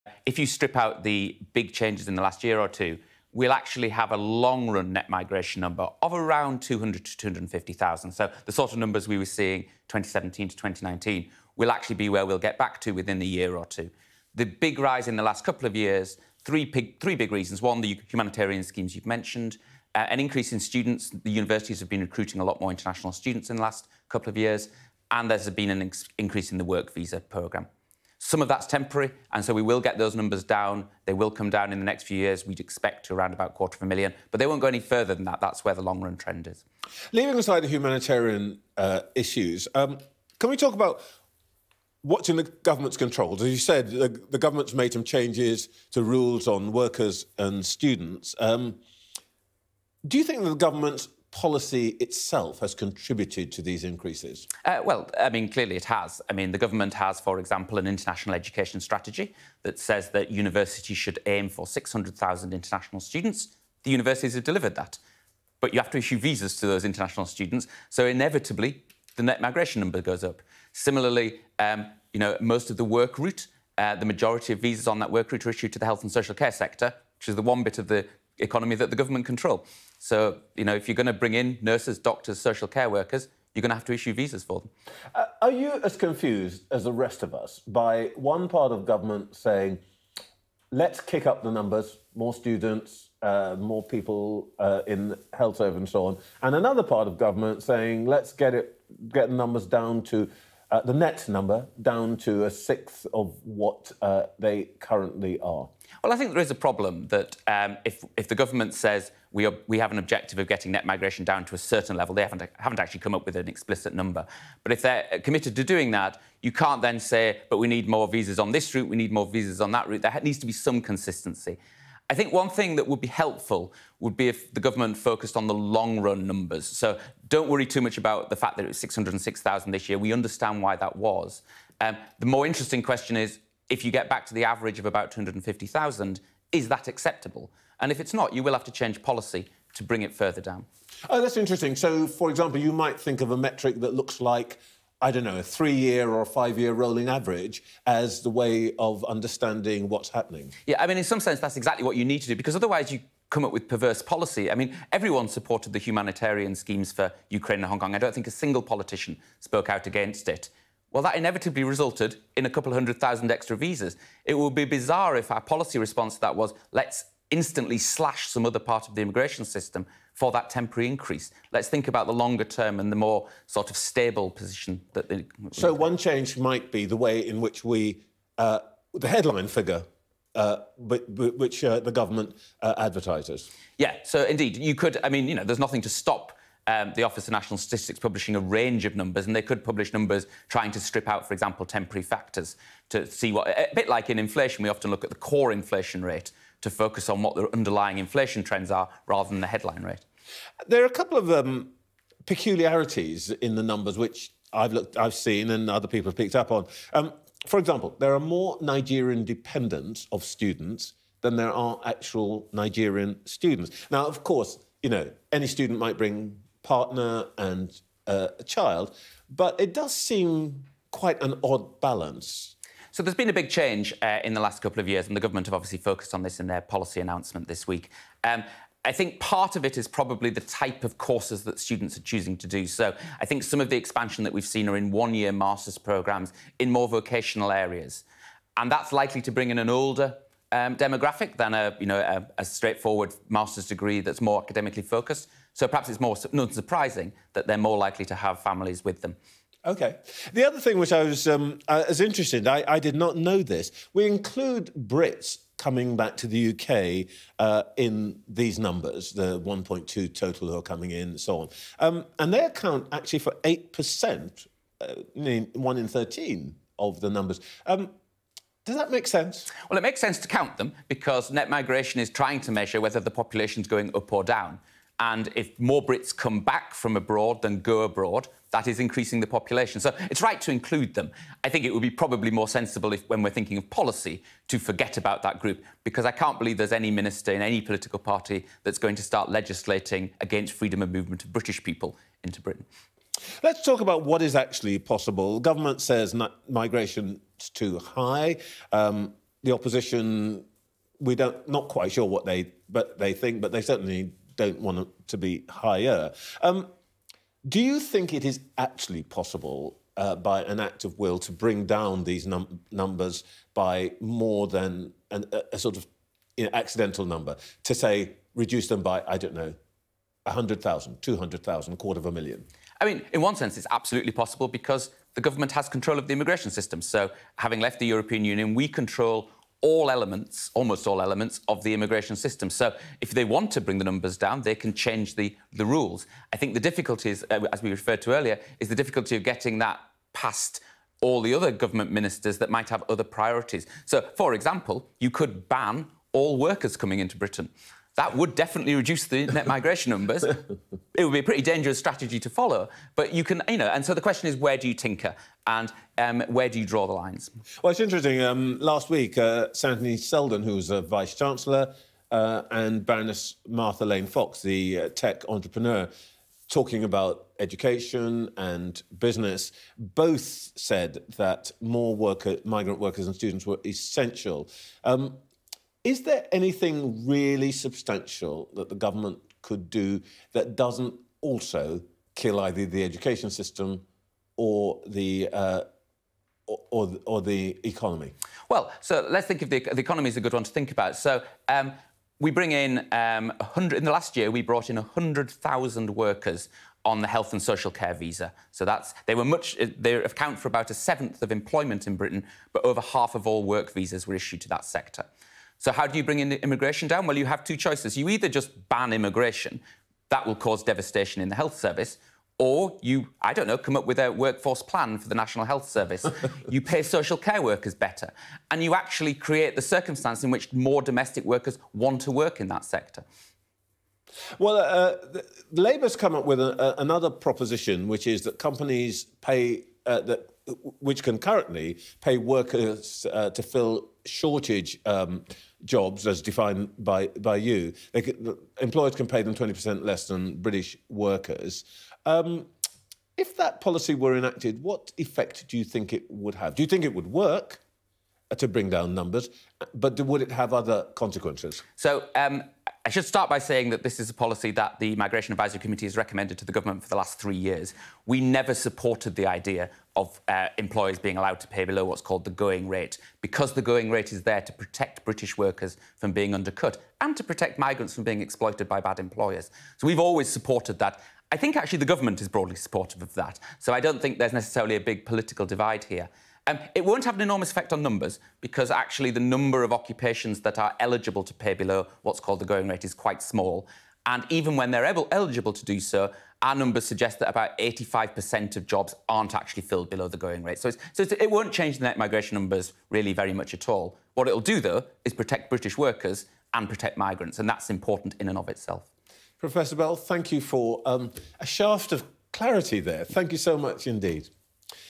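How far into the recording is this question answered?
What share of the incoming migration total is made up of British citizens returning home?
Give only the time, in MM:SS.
04:23.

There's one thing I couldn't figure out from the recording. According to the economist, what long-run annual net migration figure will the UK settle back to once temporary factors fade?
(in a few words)
200,000 to 250,000.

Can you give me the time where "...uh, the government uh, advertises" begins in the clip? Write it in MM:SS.
03:01.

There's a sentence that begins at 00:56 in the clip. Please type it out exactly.
I mean, the government has, for example, an international education strategy that says that universities should aim for 600,000 international students.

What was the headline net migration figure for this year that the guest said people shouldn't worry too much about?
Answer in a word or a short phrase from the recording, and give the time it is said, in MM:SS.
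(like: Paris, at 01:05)
606,000, at 02:08.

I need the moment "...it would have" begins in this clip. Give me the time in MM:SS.
07:25.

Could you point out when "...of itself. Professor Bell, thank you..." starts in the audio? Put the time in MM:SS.
08:18.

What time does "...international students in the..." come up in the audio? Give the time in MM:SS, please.
00:22.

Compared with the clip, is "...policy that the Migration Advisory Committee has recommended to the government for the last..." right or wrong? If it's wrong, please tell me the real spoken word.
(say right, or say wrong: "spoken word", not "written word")
right.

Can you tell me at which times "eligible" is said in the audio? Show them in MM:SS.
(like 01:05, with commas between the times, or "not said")
08:00, 08:05.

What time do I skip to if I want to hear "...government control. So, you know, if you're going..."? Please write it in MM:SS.
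01:18.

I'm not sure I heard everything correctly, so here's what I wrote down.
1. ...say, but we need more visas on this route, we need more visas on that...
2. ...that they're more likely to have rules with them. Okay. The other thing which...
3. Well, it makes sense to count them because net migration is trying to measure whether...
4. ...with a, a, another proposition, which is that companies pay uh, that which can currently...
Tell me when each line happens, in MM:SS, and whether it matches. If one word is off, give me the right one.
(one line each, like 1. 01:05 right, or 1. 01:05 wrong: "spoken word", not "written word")
1. 01:56 right
2. 04:07 wrong: "families", not "rules"
3. 04:29 right
4. 07:06 right.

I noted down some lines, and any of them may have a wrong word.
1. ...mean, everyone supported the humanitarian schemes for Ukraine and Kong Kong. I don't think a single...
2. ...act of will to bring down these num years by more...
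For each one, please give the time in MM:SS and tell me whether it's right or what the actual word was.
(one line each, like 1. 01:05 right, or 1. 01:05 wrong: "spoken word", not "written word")
1. 02:34 wrong: "Hong", not "Kong"
2. 05:10 wrong: "numbers", not "years".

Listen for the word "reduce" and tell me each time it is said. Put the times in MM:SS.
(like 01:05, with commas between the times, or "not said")
05:18, 05:48.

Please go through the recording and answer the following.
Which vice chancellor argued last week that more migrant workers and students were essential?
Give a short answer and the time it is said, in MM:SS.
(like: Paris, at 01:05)
Anthony Seldon, at 05:59.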